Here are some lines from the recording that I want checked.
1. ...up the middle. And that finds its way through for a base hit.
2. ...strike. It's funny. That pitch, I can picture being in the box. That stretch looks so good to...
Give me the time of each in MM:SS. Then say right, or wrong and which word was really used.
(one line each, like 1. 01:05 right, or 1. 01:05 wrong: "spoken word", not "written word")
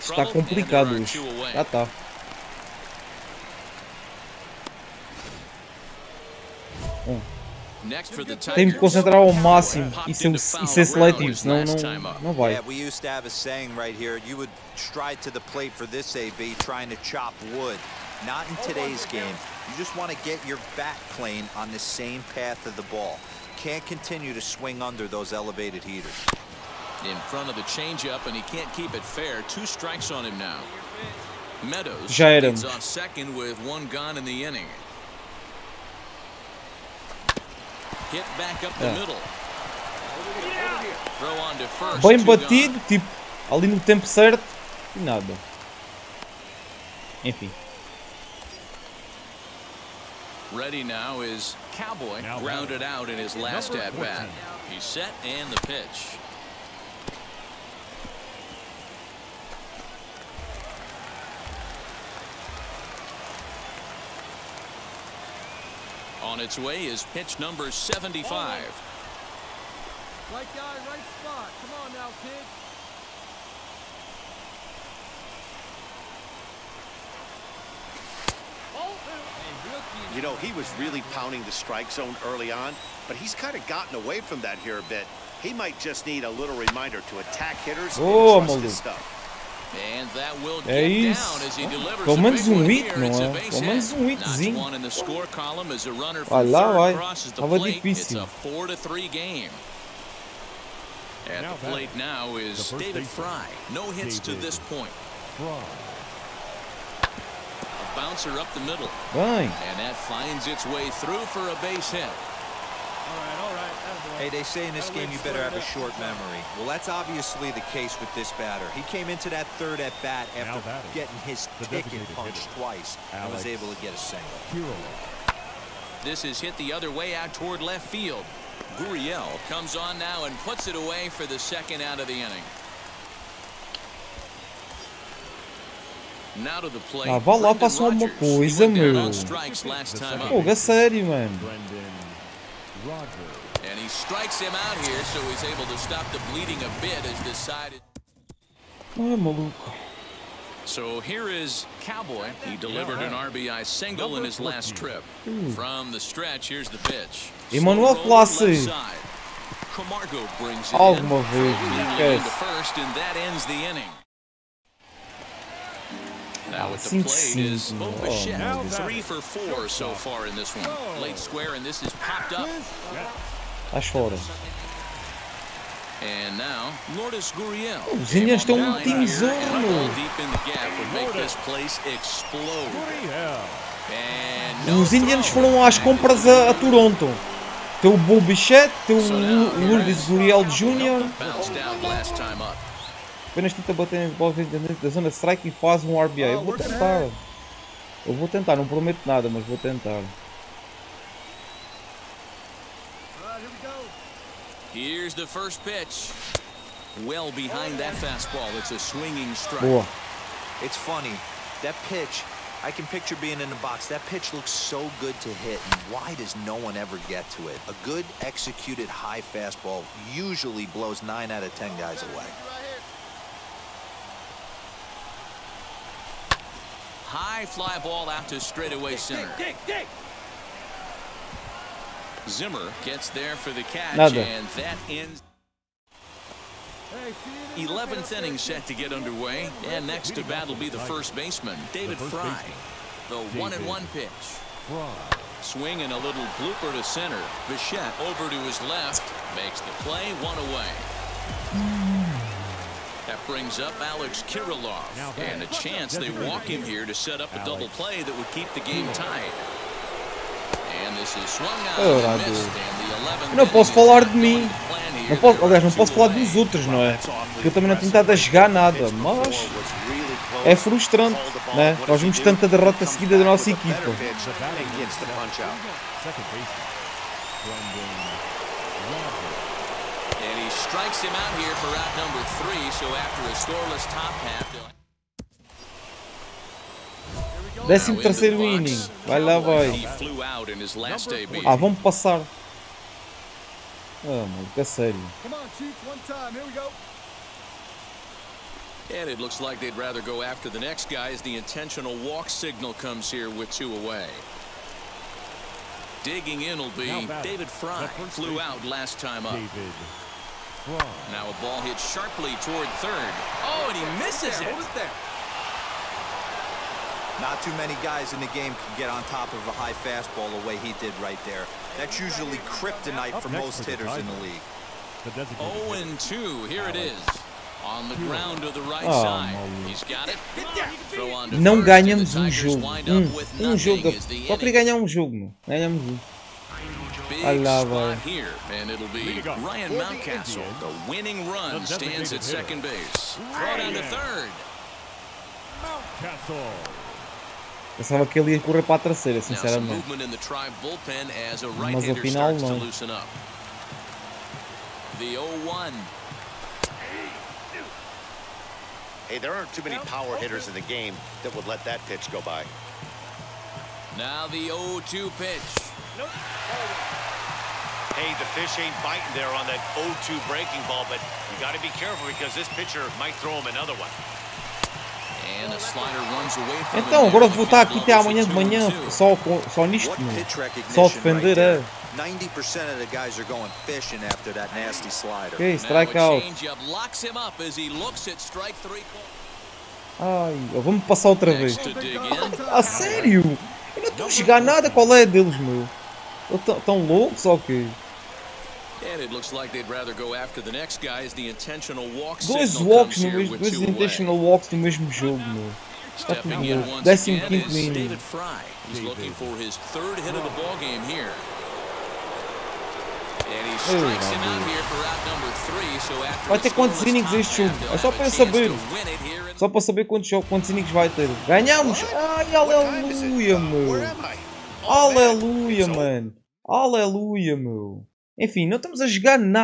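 1. 01:48 right
2. 03:29 wrong: "pitch", not "stretch".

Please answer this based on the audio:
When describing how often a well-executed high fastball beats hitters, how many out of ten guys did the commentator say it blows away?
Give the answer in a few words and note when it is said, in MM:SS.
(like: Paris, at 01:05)
9, at 03:41.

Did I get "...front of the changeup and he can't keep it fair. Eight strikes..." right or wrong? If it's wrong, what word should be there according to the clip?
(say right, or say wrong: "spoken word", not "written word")
wrong: "Two", not "Eight".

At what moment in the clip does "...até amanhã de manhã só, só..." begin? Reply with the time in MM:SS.
06:17.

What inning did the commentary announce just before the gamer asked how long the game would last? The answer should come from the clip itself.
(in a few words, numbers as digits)
15.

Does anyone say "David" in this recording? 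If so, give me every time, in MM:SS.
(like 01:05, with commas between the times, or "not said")
01:42, 04:01, 05:07.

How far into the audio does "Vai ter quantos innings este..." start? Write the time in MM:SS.
06:56.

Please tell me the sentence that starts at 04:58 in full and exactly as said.
And it looks like they'd rather go after the next guy as the intentional walk signal comes here with two away.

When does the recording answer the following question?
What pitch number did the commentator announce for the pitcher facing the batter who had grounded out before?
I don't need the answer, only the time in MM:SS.
01:07.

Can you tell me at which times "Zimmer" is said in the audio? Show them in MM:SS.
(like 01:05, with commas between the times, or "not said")
03:52.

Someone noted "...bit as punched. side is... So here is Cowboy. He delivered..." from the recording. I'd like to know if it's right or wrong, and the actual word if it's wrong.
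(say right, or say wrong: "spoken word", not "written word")
wrong: "decided", not "punched".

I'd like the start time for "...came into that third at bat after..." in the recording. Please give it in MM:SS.
01:58.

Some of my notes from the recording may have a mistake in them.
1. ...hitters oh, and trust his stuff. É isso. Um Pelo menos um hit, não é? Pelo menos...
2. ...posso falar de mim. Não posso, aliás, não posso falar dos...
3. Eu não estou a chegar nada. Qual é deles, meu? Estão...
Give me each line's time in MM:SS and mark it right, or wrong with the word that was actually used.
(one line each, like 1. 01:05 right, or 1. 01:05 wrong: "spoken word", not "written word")
1. 01:27 right
2. 04:23 right
3. 06:33 right.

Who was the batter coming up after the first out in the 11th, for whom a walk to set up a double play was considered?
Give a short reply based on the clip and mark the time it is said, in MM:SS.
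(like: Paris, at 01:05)
Alex Kirilloff, at 04:13.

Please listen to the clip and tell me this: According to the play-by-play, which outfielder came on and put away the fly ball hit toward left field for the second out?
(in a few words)
Gurriel.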